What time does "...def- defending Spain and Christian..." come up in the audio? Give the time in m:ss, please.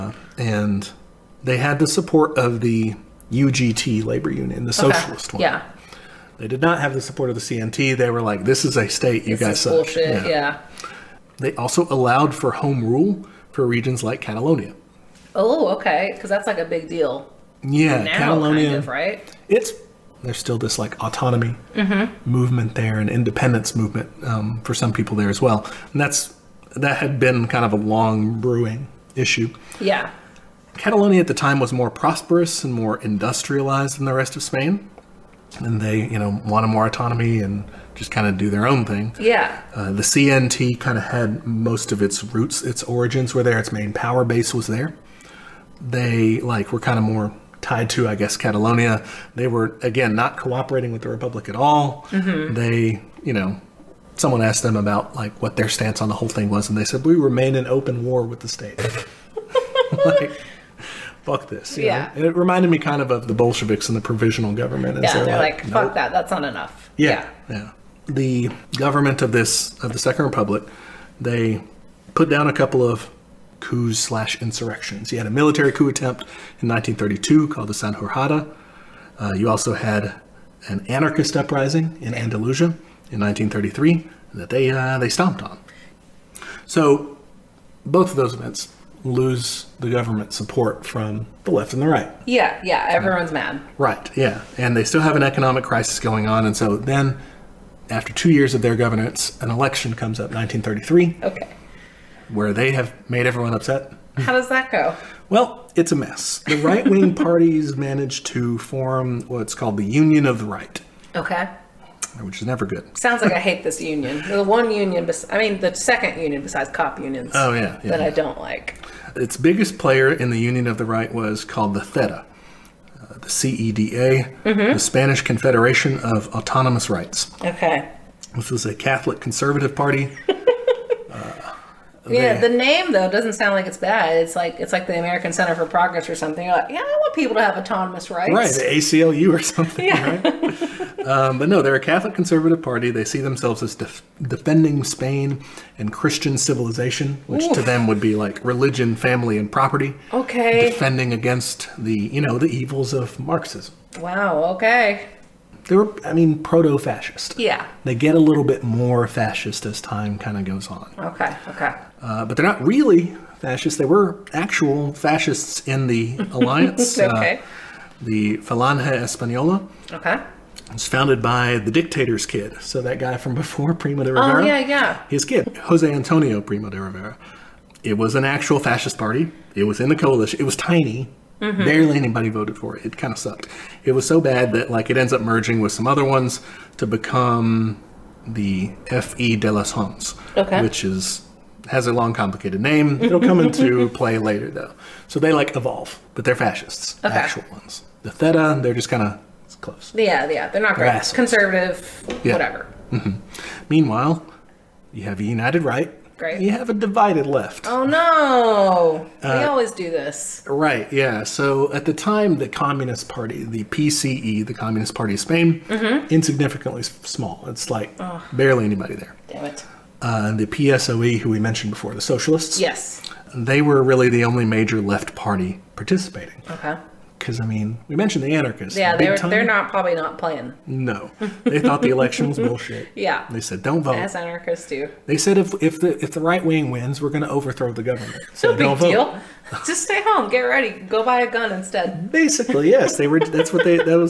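2:23.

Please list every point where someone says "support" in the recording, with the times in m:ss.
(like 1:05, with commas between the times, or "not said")
0:01, 0:07, 1:30.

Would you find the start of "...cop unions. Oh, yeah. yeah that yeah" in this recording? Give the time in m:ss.
1:56.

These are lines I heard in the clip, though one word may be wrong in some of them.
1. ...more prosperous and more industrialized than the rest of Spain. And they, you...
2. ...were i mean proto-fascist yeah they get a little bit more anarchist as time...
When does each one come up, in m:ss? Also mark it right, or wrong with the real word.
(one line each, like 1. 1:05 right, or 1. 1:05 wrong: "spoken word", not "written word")
1. 0:31 right
2. 2:35 wrong: "fascist", not "anarchist".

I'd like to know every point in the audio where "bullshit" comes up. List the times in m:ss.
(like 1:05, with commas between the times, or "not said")
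0:09, 3:52.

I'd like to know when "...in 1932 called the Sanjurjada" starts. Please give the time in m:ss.
1:16.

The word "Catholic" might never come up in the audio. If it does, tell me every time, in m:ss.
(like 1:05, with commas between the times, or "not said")
2:08, 2:21.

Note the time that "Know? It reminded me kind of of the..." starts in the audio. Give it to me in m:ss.
1:02.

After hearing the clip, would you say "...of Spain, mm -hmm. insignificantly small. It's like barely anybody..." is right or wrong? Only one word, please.
right.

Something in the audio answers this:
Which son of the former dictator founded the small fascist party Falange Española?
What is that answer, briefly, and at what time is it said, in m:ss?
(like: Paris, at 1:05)
Jose Antonio Primo de Rivera, at 2:55.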